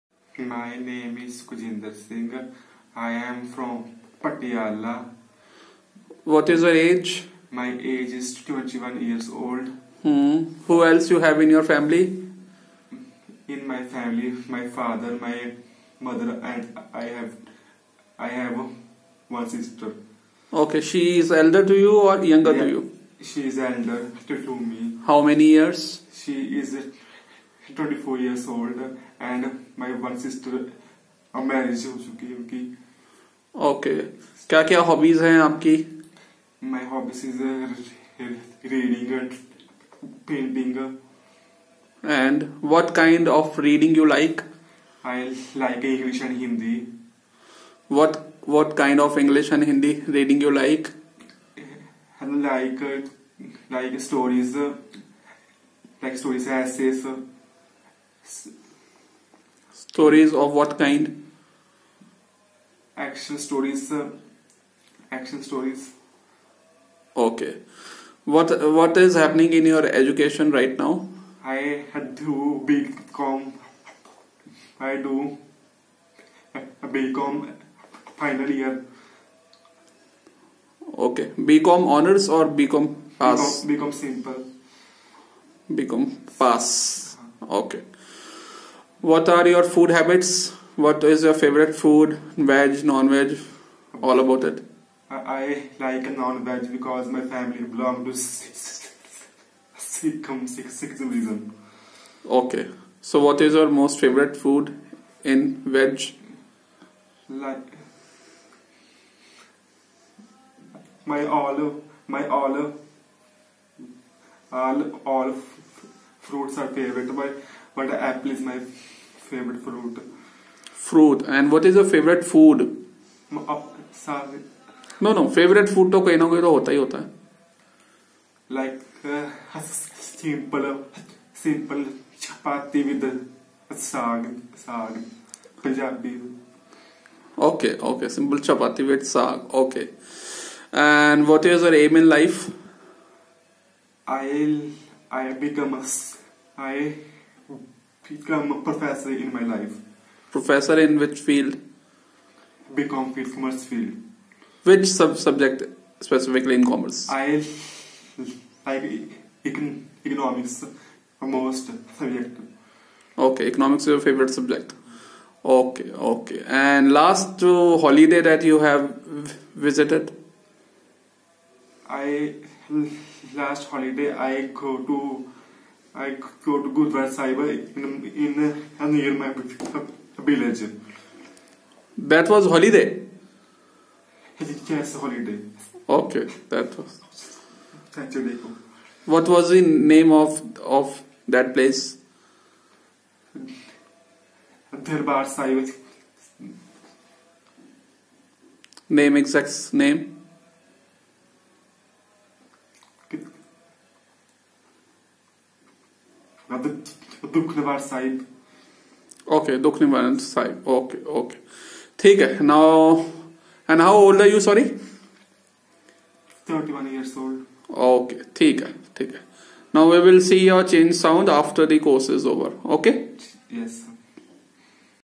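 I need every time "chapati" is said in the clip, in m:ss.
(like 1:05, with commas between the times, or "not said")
2:18.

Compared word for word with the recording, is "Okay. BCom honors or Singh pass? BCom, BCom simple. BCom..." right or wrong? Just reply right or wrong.
wrong.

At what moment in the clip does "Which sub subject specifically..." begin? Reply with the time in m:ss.
2:34.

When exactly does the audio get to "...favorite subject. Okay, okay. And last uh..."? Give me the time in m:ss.
2:43.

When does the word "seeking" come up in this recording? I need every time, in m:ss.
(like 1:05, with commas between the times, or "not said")
not said.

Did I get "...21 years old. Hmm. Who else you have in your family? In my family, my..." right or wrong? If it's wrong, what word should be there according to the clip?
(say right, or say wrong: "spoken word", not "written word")
right.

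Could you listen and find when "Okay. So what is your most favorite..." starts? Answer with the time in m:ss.
1:42.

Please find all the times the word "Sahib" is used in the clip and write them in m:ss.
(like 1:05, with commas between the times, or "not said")
2:57, 3:15.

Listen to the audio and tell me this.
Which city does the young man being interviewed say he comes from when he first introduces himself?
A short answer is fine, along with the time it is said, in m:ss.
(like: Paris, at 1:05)
Patiala, at 0:04.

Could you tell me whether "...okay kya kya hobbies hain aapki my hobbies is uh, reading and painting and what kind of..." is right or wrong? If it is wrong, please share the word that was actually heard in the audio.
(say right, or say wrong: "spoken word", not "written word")
right.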